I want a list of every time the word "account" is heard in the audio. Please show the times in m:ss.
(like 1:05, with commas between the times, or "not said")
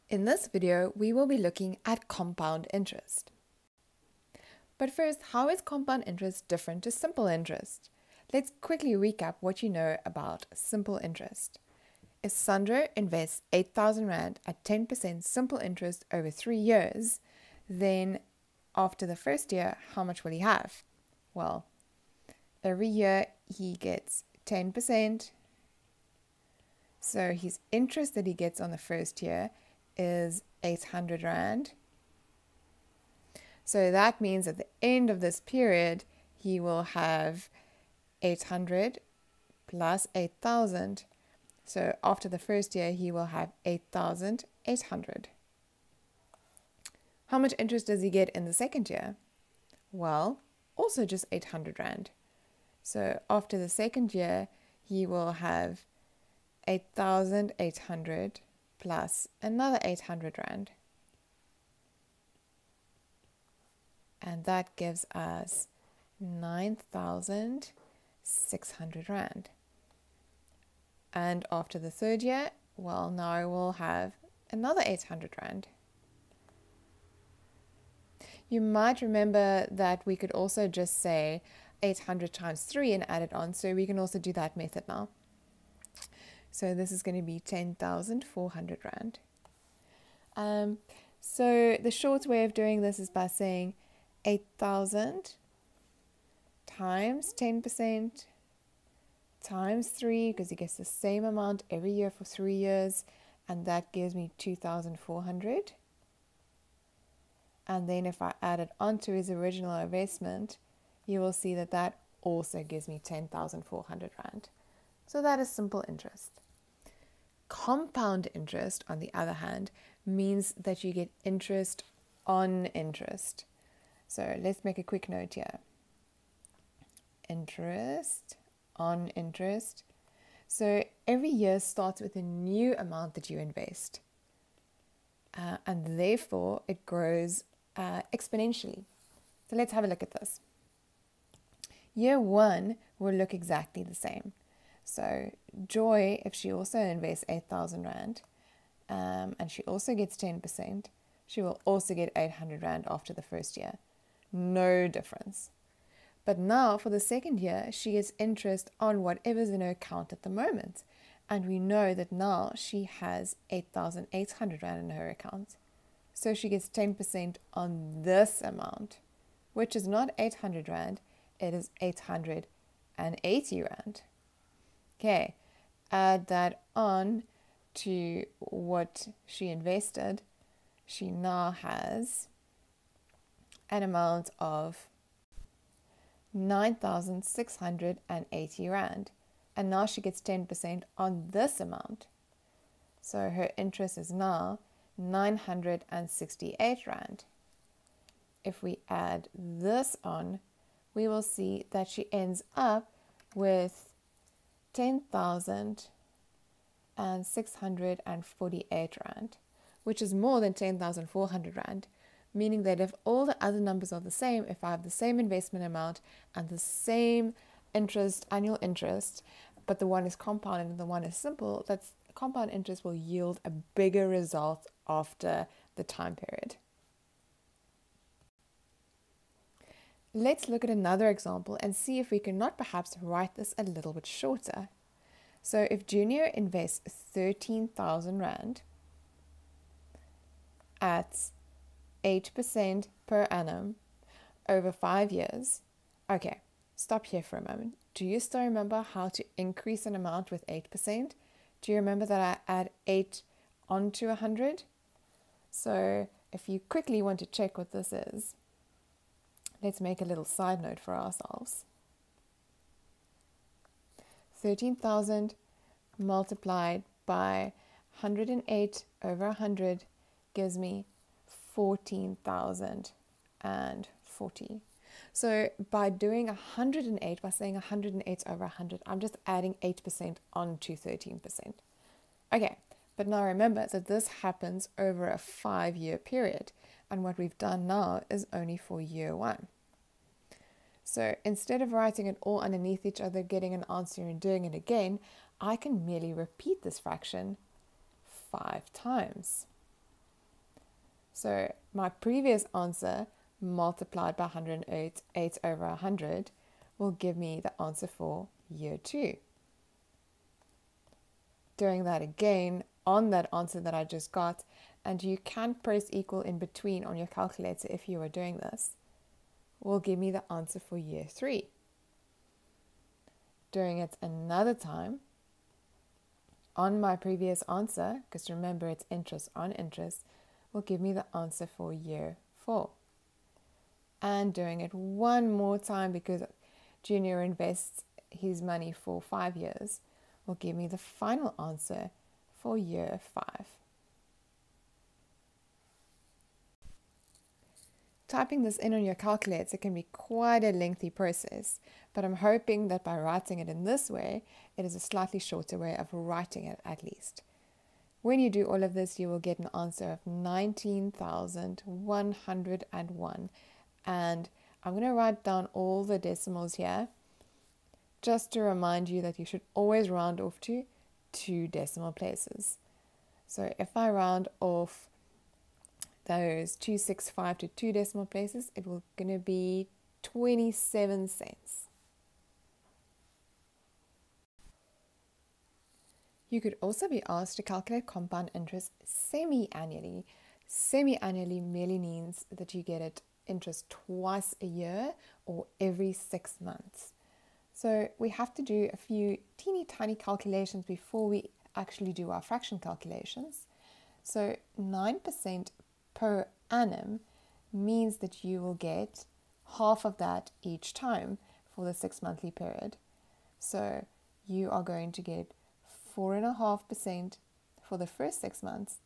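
2:39, 2:45.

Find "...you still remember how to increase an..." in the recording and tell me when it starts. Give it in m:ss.
4:08.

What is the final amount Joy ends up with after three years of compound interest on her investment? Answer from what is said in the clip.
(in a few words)
10,648 Rand.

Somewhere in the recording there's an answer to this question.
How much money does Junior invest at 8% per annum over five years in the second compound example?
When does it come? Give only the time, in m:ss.
3:56.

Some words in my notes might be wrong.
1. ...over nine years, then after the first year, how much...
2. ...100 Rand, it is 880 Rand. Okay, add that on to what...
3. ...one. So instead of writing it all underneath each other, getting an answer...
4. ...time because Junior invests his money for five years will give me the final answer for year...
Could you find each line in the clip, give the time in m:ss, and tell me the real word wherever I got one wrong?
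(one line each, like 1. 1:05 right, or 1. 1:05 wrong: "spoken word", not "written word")
1. 0:16 wrong: "three", not "nine"
2. 2:50 wrong: "800", not "100"
3. 4:49 right
4. 5:35 right.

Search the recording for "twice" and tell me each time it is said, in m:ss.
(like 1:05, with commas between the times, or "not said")
6:33.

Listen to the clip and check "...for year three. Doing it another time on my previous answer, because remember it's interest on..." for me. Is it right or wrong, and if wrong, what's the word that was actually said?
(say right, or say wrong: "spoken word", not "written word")
right.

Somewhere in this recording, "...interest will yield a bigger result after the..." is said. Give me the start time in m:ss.
3:42.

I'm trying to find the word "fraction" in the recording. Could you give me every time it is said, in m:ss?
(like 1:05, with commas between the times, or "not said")
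4:56, 6:42.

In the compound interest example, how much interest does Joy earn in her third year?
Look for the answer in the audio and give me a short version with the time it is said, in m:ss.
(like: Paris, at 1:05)
968 Rand, at 3:14.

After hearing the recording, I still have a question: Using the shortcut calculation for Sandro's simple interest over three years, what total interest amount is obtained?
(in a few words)
2,400.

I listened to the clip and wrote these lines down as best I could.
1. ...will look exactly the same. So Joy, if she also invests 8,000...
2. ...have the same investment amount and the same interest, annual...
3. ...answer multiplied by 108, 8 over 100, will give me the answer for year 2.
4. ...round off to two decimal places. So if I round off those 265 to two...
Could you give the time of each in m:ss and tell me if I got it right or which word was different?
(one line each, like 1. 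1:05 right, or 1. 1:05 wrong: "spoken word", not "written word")
1. 2:23 right
2. 3:34 right
3. 5:02 right
4. 6:09 right.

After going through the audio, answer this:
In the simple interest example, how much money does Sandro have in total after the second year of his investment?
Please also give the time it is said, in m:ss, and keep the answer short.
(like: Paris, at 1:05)
9,600 Rand, at 1:06.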